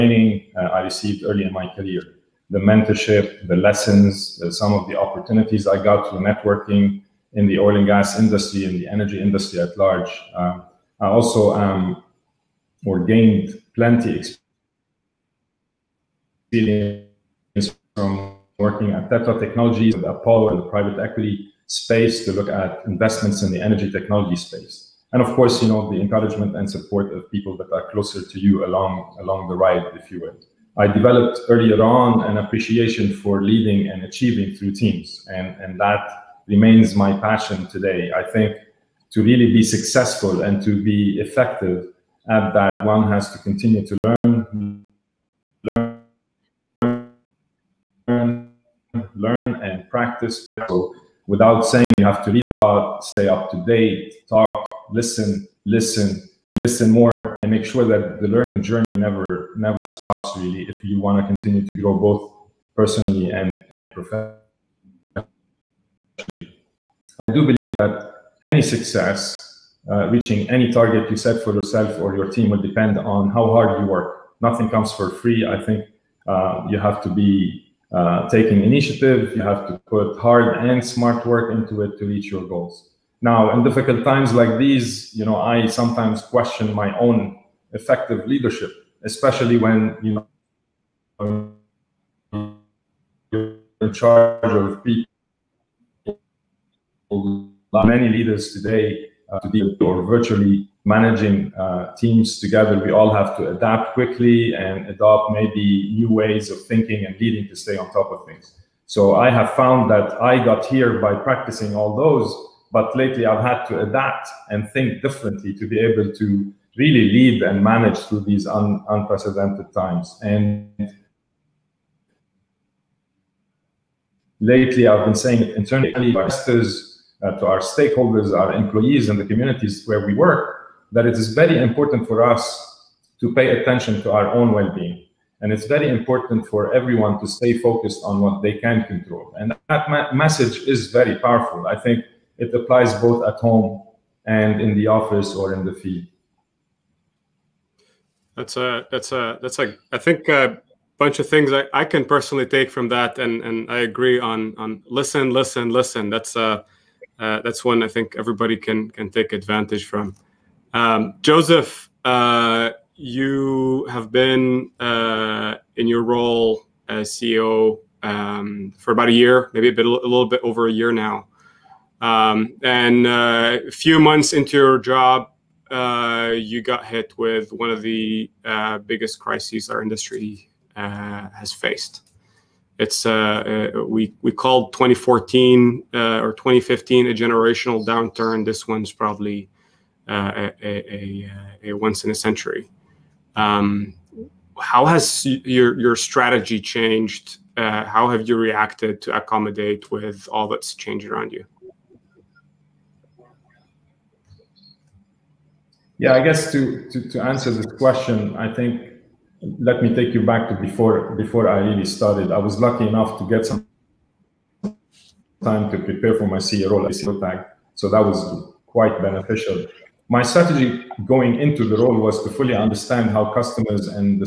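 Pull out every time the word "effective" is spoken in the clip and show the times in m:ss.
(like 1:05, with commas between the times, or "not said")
0:41, 1:27.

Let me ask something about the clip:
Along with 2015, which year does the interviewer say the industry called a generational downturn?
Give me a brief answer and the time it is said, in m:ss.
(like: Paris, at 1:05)
2014, at 3:04.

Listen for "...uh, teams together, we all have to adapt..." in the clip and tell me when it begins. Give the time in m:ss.
1:41.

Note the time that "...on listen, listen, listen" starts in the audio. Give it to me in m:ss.
2:34.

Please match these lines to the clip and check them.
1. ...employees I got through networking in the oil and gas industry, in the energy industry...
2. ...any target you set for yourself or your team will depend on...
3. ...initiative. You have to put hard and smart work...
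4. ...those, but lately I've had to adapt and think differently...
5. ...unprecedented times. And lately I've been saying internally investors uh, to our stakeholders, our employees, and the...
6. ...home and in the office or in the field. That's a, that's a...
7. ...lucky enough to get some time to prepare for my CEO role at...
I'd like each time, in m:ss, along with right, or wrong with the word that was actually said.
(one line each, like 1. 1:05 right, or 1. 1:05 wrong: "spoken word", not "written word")
1. 0:04 wrong: "opportunities", not "employees"
2. 1:10 right
3. 1:18 right
4. 1:51 right
5. 1:58 right
6. 2:23 right
7. 3:32 right.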